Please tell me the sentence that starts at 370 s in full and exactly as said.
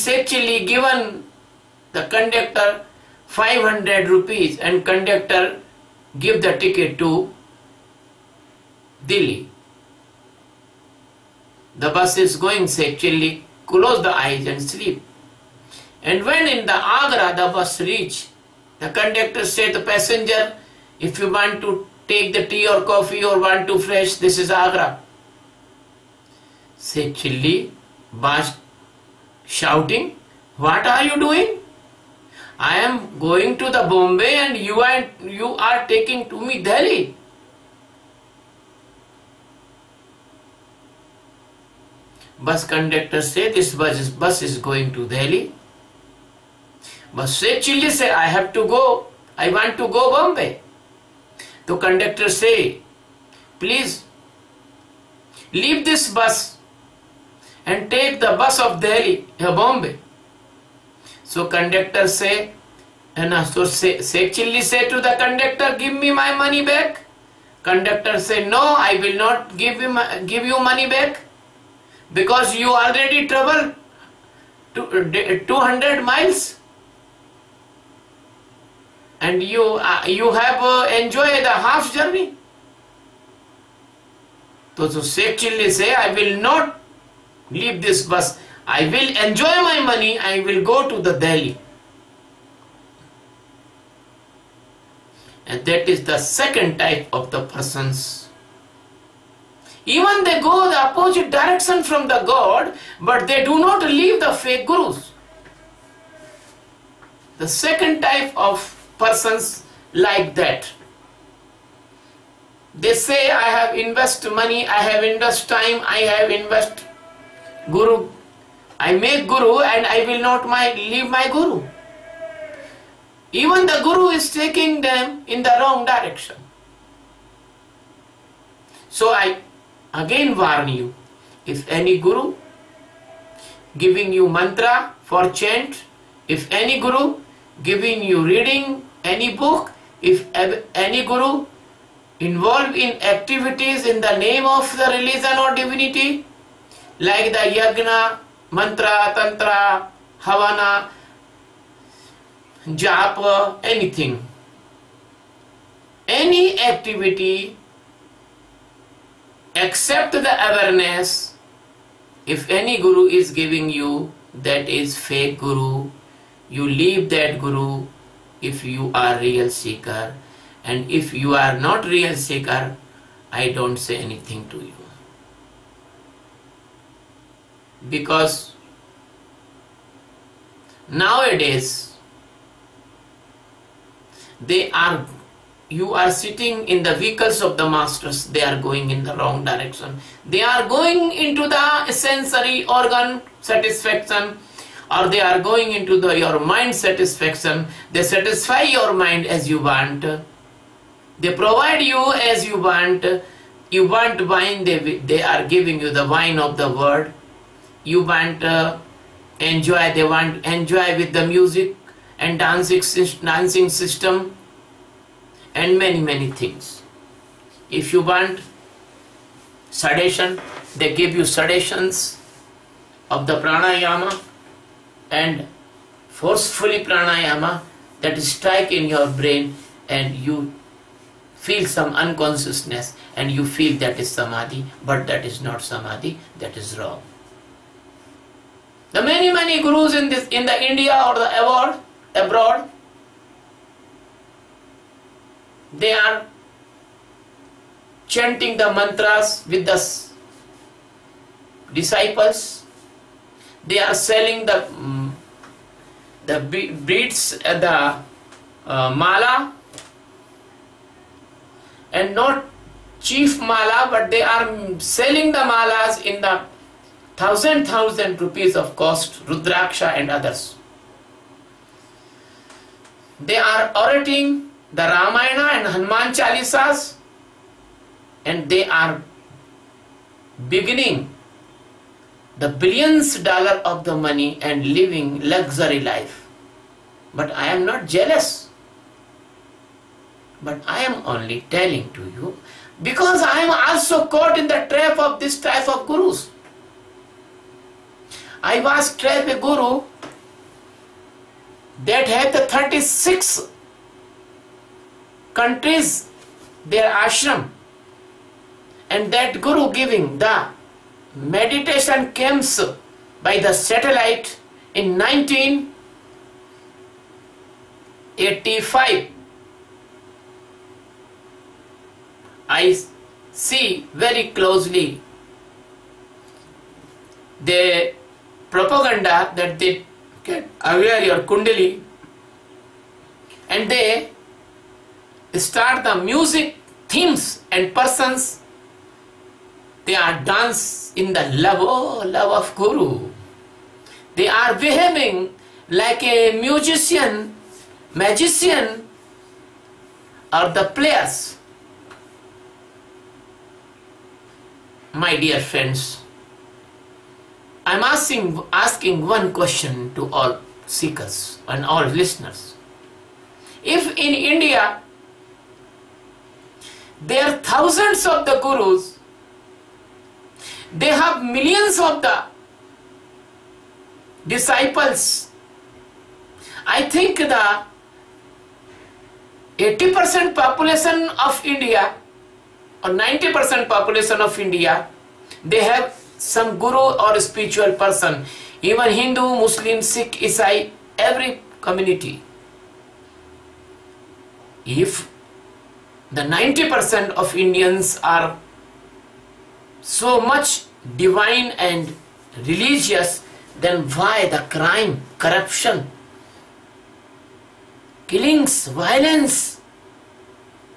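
They have millions of the disciples.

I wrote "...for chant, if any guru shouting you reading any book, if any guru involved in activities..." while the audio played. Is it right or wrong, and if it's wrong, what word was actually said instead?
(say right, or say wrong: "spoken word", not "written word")
wrong: "giving", not "shouting".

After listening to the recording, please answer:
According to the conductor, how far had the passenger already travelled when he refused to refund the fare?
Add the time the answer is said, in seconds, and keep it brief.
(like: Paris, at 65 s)
200 miles, at 74 s.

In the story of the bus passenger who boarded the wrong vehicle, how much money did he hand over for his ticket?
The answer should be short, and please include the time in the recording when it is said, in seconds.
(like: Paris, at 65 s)
500 rupees, at 3 s.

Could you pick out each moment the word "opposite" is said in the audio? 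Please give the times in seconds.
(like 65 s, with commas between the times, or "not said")
100 s.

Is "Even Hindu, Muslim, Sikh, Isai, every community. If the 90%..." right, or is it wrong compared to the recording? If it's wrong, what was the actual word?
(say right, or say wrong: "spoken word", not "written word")
right.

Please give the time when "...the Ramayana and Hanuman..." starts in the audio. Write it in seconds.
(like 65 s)
274 s.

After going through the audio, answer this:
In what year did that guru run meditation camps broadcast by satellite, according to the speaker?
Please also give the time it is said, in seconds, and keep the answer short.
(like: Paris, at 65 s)
1985, at 314 s.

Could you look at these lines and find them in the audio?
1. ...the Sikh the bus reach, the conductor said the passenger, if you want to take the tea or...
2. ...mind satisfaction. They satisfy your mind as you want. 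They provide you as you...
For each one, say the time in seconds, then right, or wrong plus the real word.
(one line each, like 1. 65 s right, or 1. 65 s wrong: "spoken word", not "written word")
1. 16 s wrong: "Agra", not "Sikh"
2. 196 s right.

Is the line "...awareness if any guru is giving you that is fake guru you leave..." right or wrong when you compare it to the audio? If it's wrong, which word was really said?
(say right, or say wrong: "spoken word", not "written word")
right.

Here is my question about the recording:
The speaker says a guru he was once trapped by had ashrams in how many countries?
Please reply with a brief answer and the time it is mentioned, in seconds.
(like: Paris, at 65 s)
36, at 302 s.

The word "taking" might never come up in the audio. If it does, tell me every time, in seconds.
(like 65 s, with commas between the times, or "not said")
35 s, 124 s.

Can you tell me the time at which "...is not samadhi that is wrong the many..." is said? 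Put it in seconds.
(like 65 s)
235 s.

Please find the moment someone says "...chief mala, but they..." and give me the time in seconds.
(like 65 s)
263 s.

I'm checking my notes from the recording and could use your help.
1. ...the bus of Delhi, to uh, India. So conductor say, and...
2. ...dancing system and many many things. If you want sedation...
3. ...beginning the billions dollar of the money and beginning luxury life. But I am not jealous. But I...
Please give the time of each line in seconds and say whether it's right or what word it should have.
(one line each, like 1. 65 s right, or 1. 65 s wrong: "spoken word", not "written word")
1. 58 s wrong: "Bombay", not "India"
2. 213 s right
3. 280 s wrong: "living", not "beginning".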